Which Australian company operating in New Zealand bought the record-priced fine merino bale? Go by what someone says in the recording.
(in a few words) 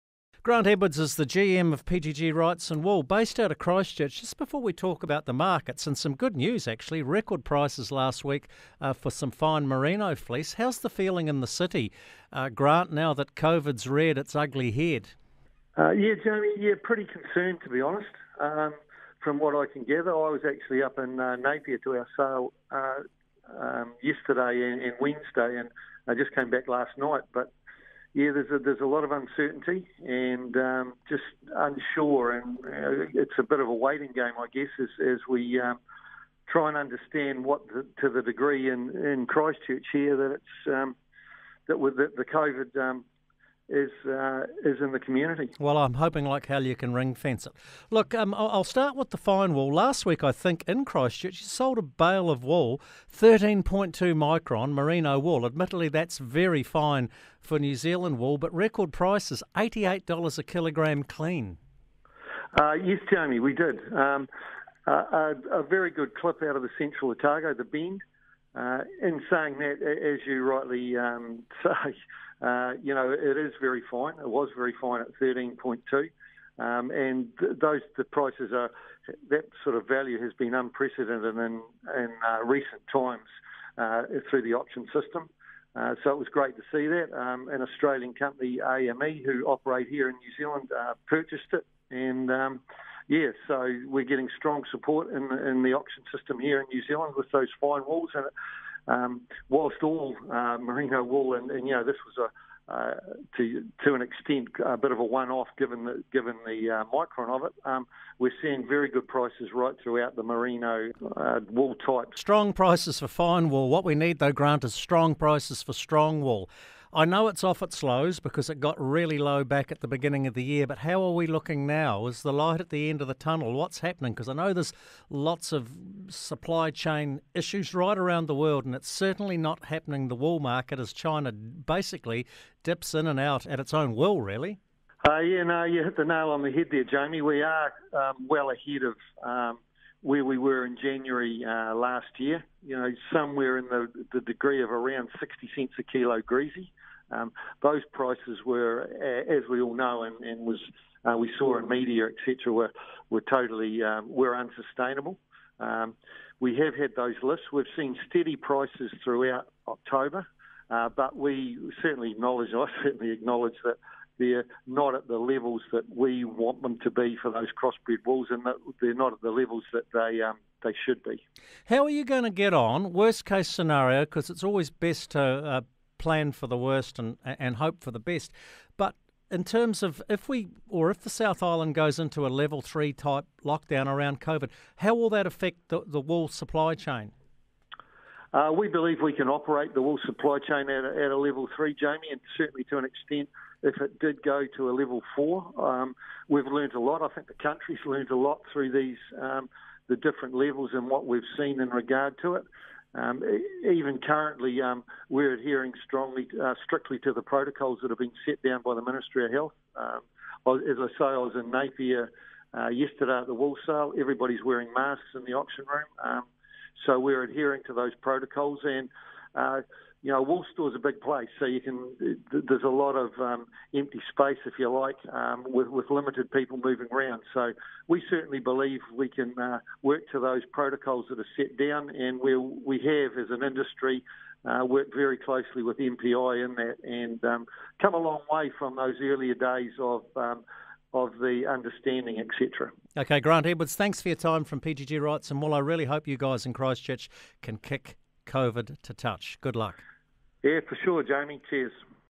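AME.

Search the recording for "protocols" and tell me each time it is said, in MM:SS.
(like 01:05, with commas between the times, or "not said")
03:27, 03:38, 03:50.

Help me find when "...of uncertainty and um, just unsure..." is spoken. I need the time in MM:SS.
00:29.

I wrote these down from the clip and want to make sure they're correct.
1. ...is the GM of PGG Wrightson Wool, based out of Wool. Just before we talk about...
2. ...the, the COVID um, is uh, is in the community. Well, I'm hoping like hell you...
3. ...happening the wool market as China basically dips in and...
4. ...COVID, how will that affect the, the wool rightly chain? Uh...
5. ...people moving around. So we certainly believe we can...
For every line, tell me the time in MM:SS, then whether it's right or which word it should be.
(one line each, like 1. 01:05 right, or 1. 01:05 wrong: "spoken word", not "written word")
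1. 00:00 wrong: "Christchurch", not "Wool"
2. 00:41 right
3. 02:09 right
4. 03:04 wrong: "supply", not "rightly"
5. 03:46 right.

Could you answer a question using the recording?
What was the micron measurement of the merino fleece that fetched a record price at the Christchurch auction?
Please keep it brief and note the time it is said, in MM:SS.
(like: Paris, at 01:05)
13.2 micron, at 00:53.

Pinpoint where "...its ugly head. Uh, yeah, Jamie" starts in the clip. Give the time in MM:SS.
00:14.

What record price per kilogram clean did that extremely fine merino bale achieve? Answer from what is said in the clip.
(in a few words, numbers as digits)
$88.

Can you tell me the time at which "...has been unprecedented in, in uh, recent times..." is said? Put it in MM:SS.
01:20.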